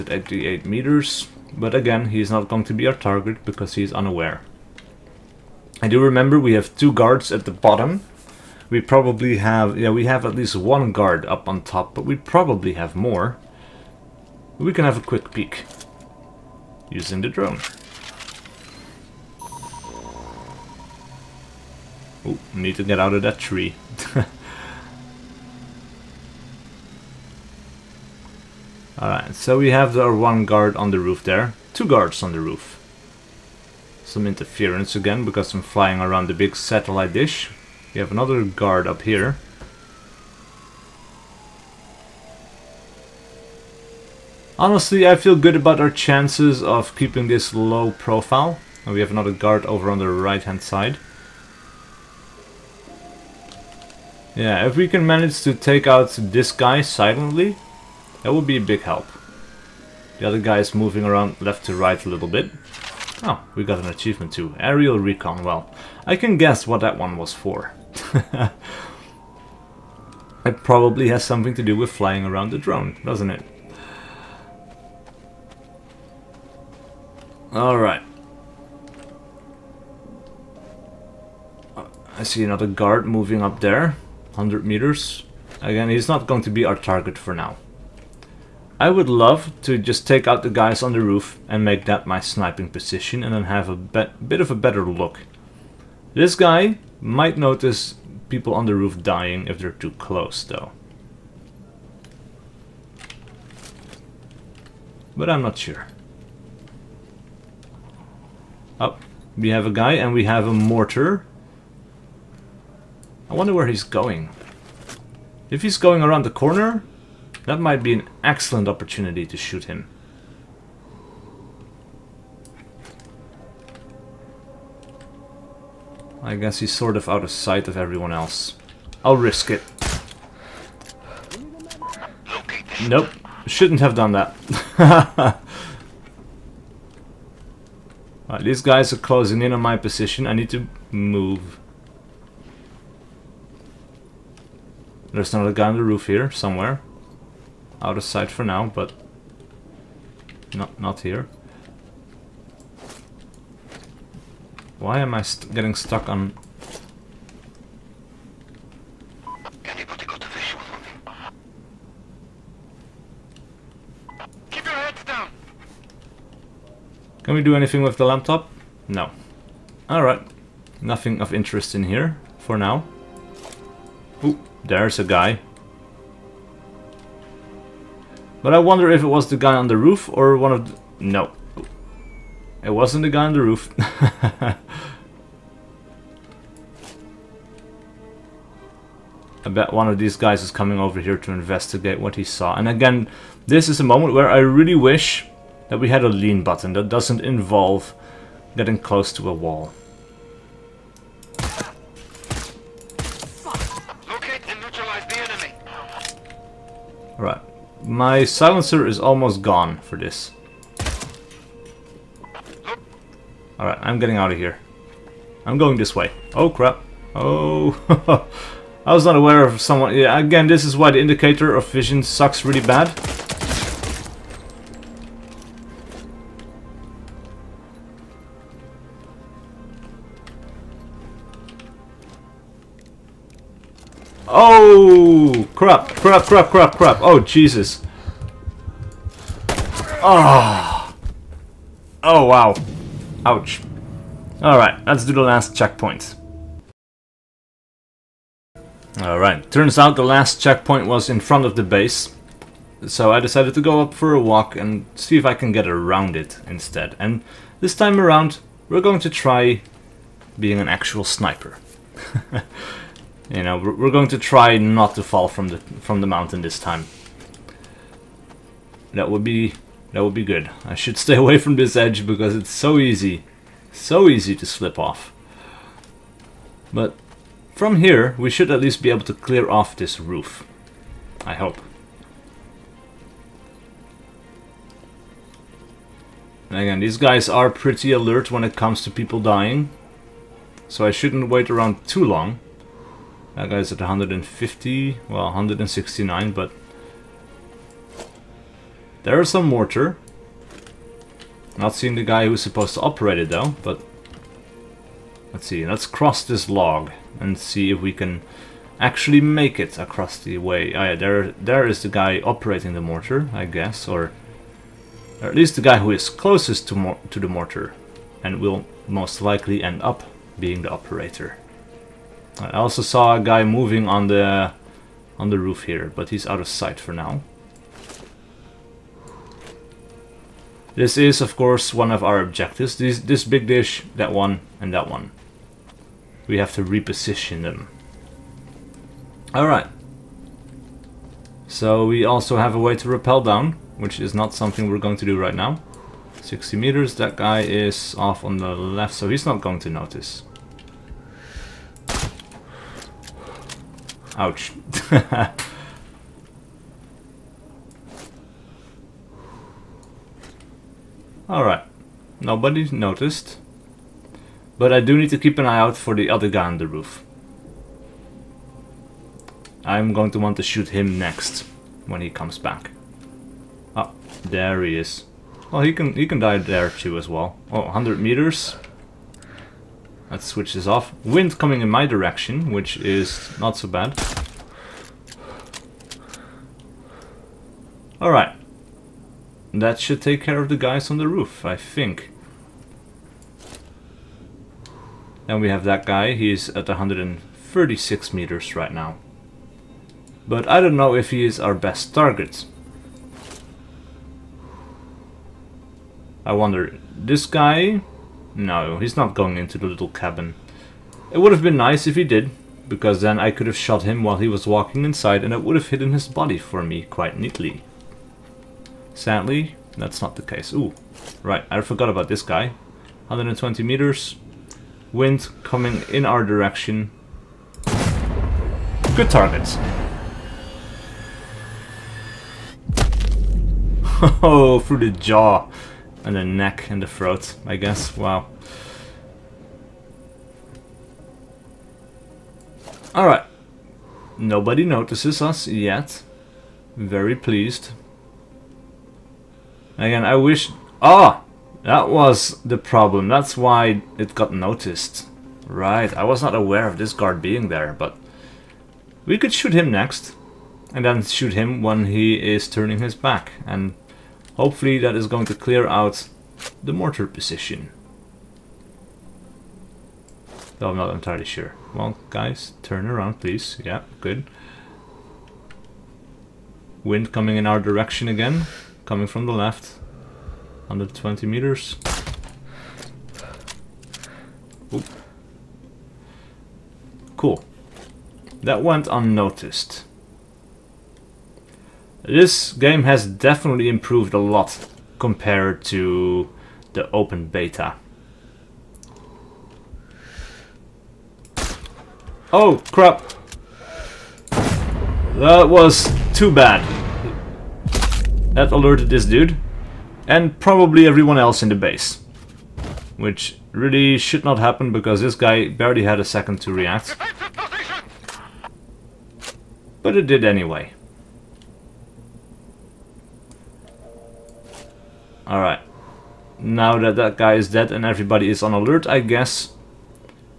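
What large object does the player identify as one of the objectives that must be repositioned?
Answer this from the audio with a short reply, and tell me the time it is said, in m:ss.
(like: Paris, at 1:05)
big dish, at 5:33.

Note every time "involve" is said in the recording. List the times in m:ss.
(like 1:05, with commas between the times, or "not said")
3:17.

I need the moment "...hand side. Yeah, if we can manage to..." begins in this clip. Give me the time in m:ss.
0:50.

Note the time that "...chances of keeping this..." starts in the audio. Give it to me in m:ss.
0:45.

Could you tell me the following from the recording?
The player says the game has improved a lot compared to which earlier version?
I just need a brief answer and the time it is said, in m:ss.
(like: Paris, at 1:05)
open beta, at 8:16.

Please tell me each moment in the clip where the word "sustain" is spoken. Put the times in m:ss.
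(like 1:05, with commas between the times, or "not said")
not said.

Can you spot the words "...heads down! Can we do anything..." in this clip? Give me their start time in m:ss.
2:44.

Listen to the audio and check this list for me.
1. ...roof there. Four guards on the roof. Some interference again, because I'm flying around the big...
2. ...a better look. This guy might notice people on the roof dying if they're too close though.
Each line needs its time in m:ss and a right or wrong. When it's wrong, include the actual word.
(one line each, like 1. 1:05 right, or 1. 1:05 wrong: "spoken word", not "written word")
1. 0:30 wrong: "Two", not "Four"
2. 1:34 right.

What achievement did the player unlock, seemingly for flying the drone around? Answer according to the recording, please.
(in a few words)
Aerial Recon.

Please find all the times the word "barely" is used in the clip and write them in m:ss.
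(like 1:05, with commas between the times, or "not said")
8:35.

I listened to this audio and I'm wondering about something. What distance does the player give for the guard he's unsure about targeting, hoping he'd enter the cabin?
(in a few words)
136 meters.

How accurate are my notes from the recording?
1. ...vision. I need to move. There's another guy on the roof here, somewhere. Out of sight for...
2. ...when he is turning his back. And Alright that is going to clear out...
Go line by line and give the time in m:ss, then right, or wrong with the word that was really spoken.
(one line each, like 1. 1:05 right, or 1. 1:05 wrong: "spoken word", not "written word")
1. 2:19 wrong: "position", not "vision"
2. 7:41 wrong: "Hopefully", not "Alright".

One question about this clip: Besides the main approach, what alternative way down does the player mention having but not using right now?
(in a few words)
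rappel down.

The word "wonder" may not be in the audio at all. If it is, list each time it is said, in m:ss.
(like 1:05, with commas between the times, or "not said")
1:53, 2:58, 6:46.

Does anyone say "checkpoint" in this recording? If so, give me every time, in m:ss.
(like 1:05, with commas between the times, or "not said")
4:05, 4:10.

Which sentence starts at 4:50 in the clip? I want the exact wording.
So I shouldn't wait around too long.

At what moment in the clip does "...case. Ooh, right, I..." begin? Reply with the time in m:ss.
7:00.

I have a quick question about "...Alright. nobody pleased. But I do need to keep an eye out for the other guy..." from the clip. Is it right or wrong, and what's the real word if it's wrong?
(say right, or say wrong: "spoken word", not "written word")
wrong: "noticed", not "pleased".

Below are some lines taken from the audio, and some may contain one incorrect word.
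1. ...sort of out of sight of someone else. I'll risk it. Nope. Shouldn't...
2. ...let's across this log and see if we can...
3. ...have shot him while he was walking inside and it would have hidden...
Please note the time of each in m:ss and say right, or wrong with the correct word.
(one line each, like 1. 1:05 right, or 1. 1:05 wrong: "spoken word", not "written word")
1. 2:06 wrong: "everyone", not "someone"
2. 5:05 wrong: "cross", not "across"
3. 6:53 right.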